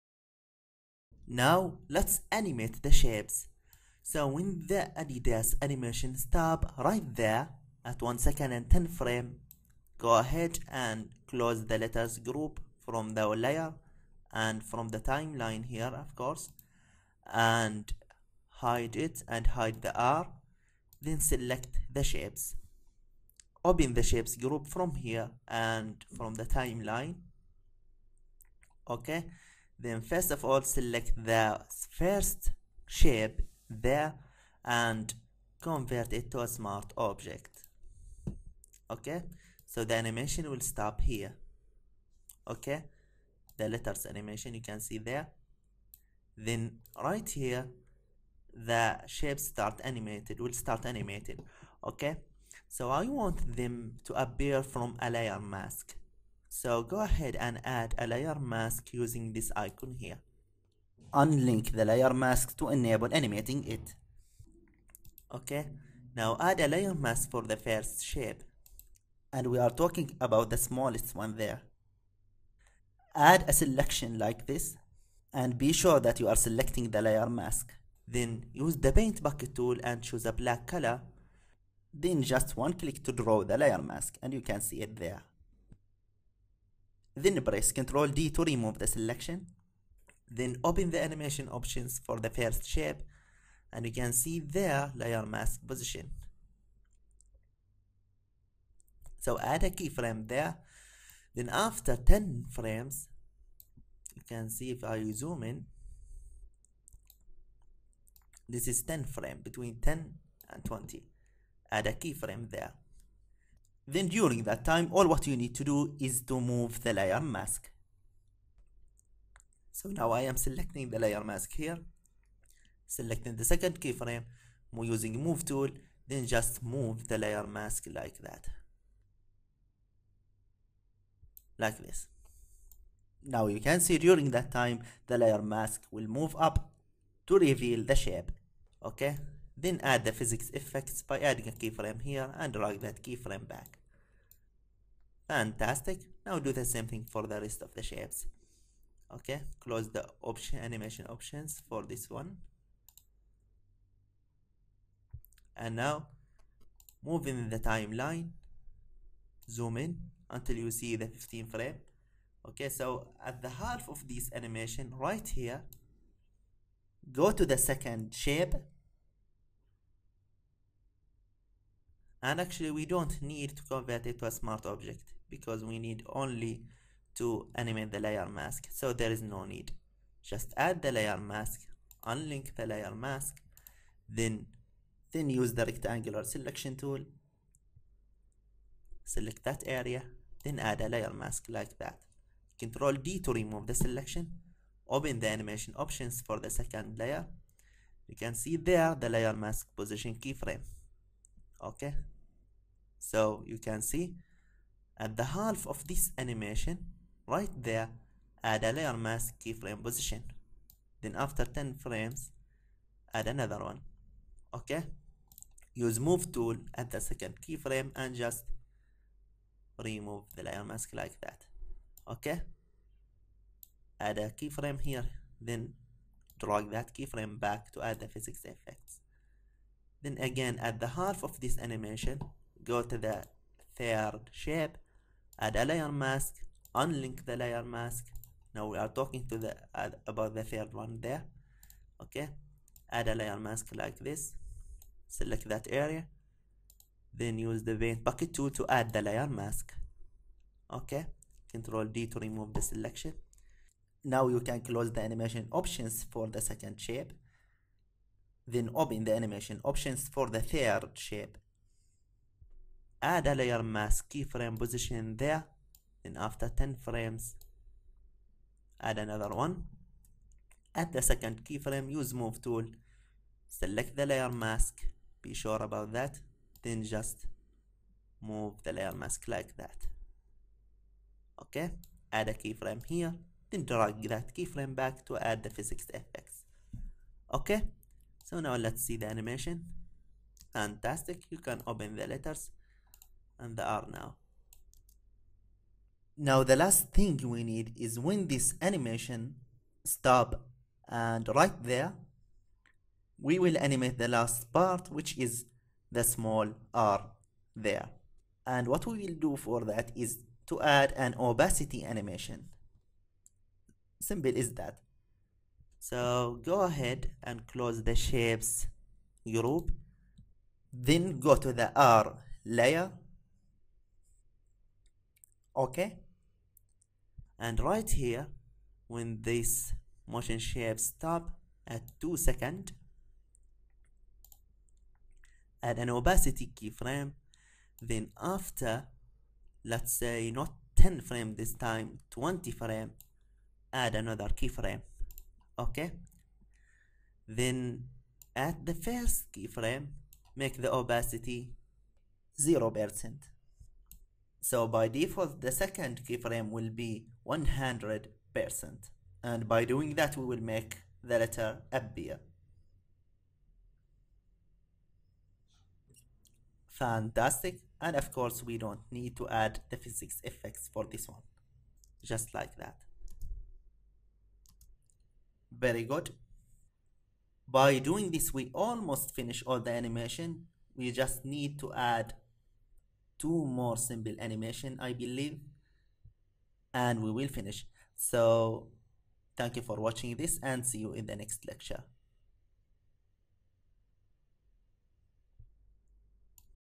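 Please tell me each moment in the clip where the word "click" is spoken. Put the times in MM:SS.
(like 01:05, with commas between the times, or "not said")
01:22.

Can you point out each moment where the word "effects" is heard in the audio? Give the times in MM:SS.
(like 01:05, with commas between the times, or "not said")
02:20, 03:48, 04:45, 06:10.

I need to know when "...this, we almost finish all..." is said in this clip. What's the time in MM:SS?
06:18.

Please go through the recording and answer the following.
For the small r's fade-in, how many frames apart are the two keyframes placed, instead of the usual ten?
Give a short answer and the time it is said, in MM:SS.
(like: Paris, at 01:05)
20, at 05:42.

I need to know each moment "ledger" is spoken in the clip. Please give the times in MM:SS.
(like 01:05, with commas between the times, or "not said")
not said.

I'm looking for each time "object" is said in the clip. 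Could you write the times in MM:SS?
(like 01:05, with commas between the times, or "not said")
00:36, 02:54.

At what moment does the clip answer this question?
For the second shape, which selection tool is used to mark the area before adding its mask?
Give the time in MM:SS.
03:05.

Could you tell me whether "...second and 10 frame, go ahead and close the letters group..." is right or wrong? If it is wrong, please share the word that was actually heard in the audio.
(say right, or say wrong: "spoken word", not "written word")
right.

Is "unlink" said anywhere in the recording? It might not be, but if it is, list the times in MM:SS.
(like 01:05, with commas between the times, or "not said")
01:01, 03:02, 03:56.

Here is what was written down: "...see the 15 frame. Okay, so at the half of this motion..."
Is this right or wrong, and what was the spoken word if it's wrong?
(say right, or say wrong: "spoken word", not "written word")
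wrong: "animation", not "motion".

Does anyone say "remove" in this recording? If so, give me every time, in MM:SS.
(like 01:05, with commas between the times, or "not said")
01:28, 03:13, 03:39, 04:12.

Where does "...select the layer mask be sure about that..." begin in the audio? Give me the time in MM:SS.
04:33.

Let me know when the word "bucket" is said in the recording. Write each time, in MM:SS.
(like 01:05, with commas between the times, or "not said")
01:19, 04:08.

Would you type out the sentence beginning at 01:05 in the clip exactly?
Okay, now add a layer mask for the first shape.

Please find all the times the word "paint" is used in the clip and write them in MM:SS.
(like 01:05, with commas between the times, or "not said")
01:18, 04:07.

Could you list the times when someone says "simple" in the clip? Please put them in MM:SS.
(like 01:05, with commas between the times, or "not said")
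05:13, 06:23.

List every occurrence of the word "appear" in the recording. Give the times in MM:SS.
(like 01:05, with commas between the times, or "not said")
00:54, 06:01.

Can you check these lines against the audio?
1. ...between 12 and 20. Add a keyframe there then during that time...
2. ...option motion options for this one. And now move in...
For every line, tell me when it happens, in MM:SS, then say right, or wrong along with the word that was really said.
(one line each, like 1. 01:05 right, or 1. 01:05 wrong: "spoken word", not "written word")
1. 01:49 wrong: "10", not "12"
2. 02:30 wrong: "animation", not "motion".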